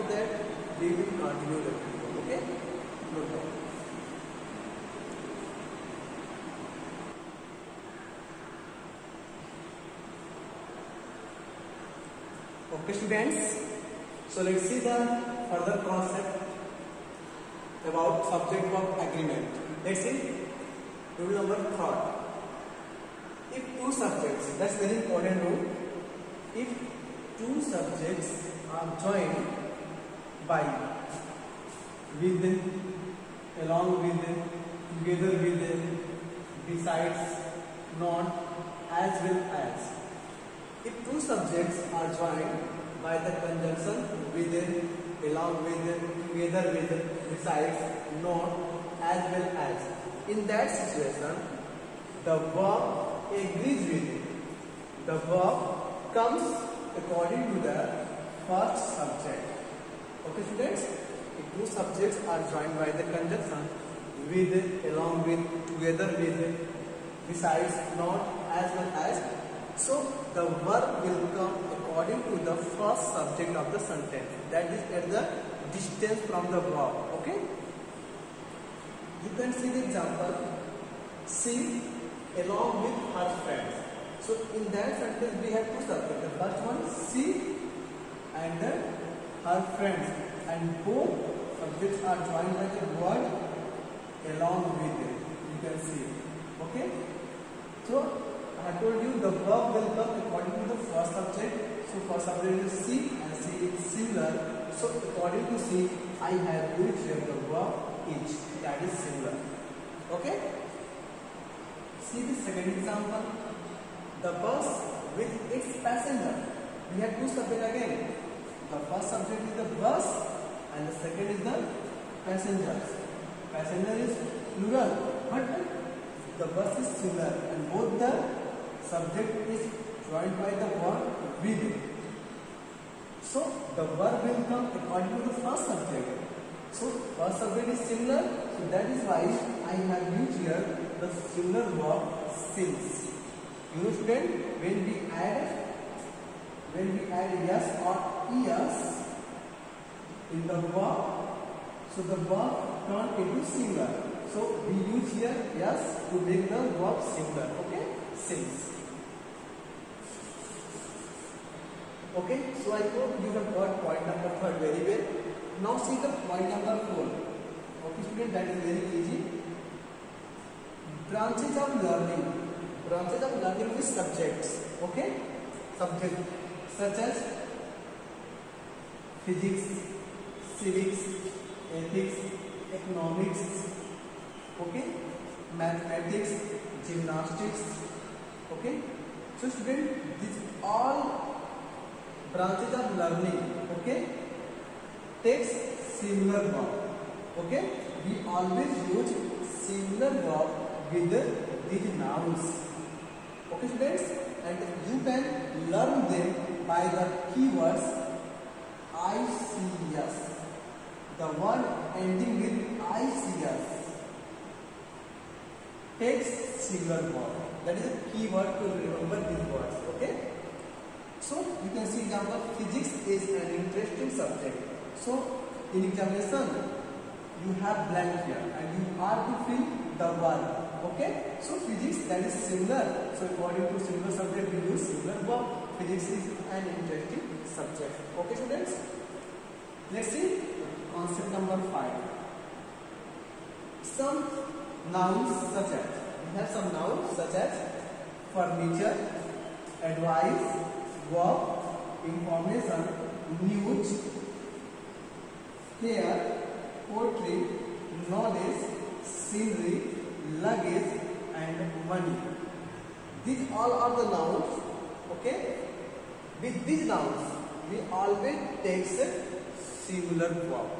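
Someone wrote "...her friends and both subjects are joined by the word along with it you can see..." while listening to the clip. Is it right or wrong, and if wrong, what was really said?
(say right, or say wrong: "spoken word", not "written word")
right.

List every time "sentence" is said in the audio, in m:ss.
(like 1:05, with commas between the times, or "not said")
1:13, 1:24.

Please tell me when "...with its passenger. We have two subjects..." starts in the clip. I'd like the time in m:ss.
1:55.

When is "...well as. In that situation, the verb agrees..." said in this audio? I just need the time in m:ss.
0:49.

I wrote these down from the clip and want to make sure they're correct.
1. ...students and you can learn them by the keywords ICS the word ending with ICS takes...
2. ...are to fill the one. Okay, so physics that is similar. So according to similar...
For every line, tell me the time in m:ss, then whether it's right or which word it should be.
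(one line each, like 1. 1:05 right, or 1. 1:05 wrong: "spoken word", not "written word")
1. 3:23 right
2. 3:49 right.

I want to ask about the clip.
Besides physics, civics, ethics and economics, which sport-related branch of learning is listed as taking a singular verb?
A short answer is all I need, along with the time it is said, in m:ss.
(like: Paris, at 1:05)
Gymnastics, at 3:06.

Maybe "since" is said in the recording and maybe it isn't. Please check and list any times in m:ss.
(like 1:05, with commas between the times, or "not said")
2:22, 2:38.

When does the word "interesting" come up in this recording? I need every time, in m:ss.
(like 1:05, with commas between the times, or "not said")
3:43, 3:56.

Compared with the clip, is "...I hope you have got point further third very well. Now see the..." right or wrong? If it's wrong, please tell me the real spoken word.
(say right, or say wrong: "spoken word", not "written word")
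wrong: "number", not "further".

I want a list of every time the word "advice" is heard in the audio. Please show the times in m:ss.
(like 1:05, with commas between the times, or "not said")
4:09.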